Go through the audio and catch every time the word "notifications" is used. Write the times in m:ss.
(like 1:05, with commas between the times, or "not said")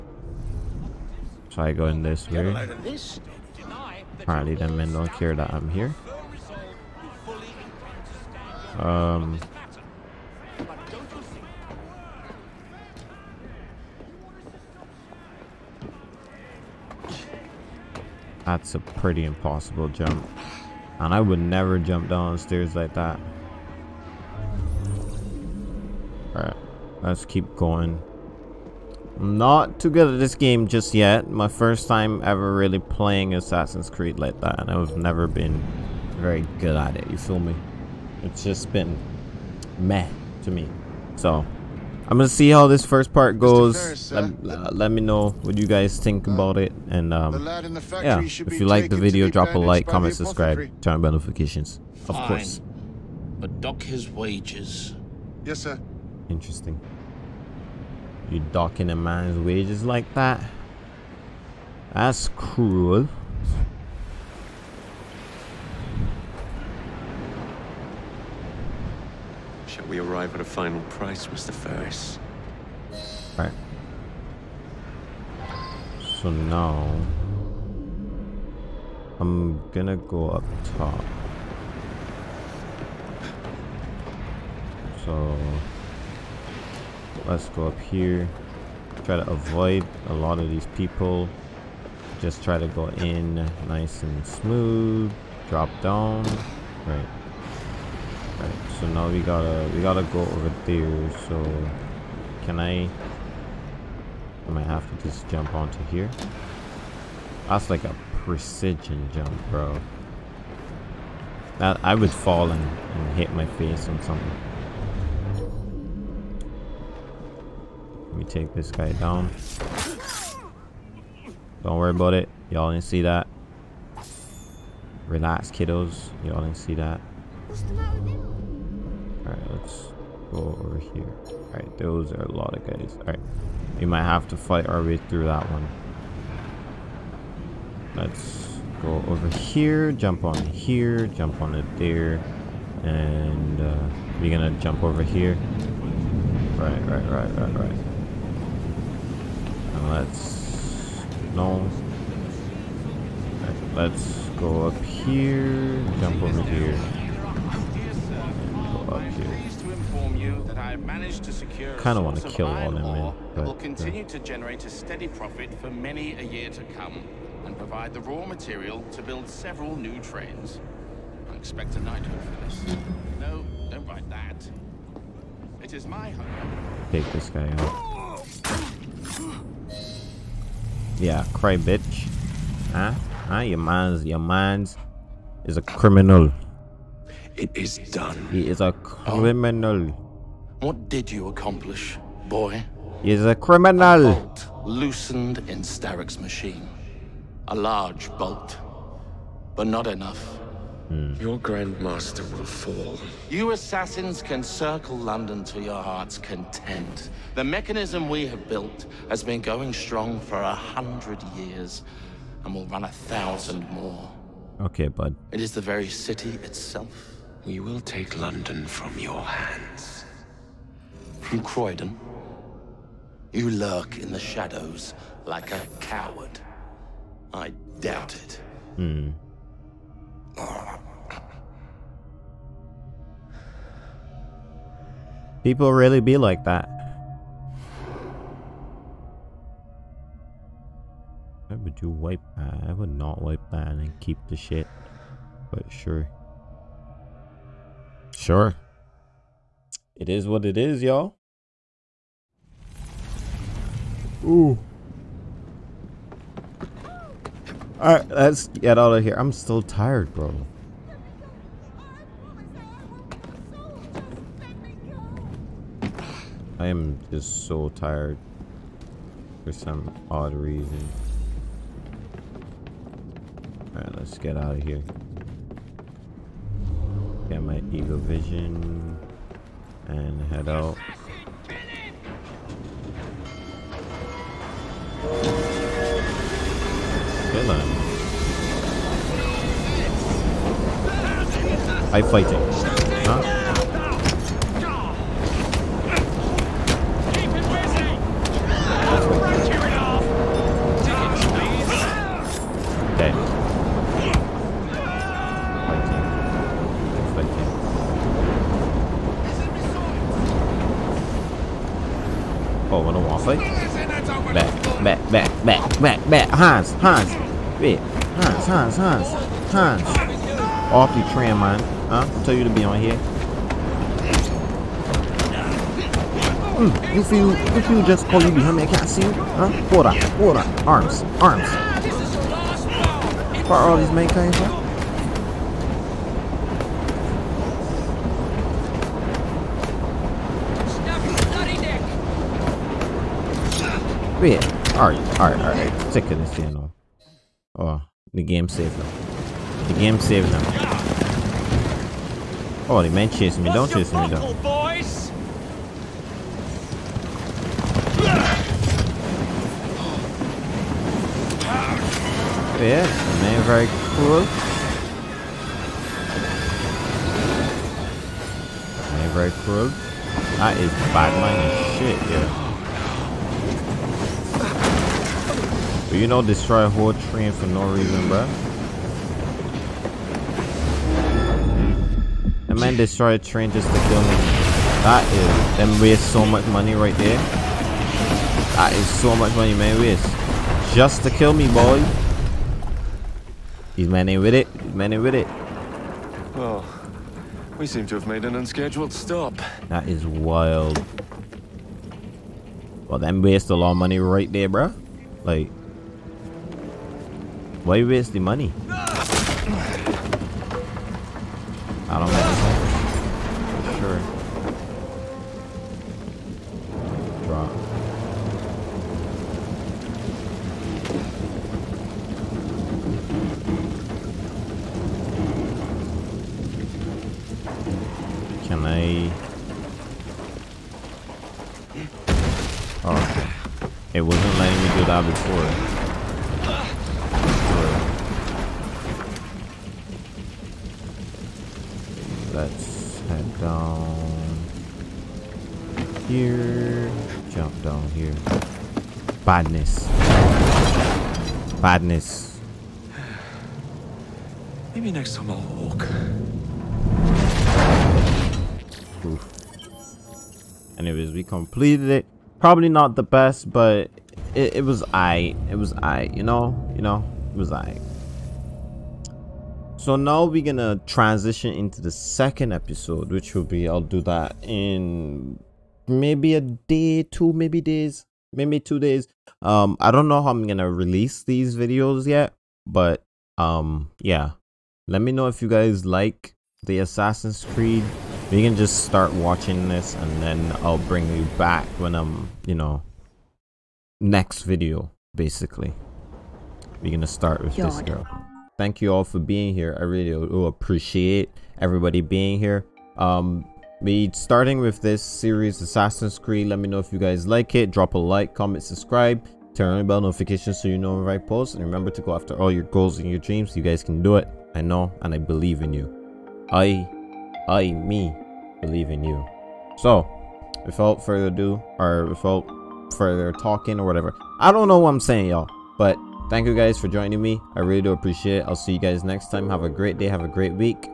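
0:51, 8:30.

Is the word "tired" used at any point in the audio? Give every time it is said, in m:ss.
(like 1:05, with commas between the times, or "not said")
4:19, 4:27.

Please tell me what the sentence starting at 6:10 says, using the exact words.
That is bad man shit, yeah.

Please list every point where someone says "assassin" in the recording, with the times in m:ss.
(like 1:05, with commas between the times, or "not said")
0:33, 3:23, 8:06, 8:25.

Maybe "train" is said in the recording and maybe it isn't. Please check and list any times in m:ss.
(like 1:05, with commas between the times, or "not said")
2:50, 6:17, 6:23.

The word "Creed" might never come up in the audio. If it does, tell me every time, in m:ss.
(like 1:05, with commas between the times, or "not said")
0:33, 8:07, 8:26.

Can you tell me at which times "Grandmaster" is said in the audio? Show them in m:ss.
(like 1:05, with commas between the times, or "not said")
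3:21.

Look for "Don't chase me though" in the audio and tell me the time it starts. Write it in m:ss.
5:53.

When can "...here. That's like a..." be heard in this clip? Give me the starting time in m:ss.
1:45.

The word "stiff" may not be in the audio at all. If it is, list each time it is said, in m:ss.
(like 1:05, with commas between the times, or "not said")
not said.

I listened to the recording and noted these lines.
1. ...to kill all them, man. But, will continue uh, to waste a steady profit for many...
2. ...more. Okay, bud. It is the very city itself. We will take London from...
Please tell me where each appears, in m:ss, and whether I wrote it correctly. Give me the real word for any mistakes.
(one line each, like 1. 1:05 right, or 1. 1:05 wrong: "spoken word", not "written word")
1. 2:42 wrong: "generate", not "waste"
2. 3:33 right.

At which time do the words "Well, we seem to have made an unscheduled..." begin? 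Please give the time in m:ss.
6:36.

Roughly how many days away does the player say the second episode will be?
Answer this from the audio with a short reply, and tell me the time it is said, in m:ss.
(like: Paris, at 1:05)
2, at 7:57.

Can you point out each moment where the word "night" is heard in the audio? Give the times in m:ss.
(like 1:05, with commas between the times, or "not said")
2:51.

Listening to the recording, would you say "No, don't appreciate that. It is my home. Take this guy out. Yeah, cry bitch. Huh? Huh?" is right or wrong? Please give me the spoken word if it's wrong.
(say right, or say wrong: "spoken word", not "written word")
wrong: "write", not "appreciate".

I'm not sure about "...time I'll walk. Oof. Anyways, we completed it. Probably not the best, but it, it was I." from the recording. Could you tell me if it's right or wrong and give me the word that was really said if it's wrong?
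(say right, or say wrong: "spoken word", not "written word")
right.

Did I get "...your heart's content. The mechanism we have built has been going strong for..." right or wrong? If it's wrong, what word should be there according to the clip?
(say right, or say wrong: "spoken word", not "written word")
right.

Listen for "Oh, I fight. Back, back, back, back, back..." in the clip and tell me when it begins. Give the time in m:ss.
5:12.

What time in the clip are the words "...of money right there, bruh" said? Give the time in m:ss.
6:43.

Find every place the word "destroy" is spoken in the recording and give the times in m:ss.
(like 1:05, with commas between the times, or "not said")
6:16, 6:22.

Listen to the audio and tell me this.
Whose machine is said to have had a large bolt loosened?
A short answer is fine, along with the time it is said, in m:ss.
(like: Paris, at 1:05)
Starrick, at 3:15.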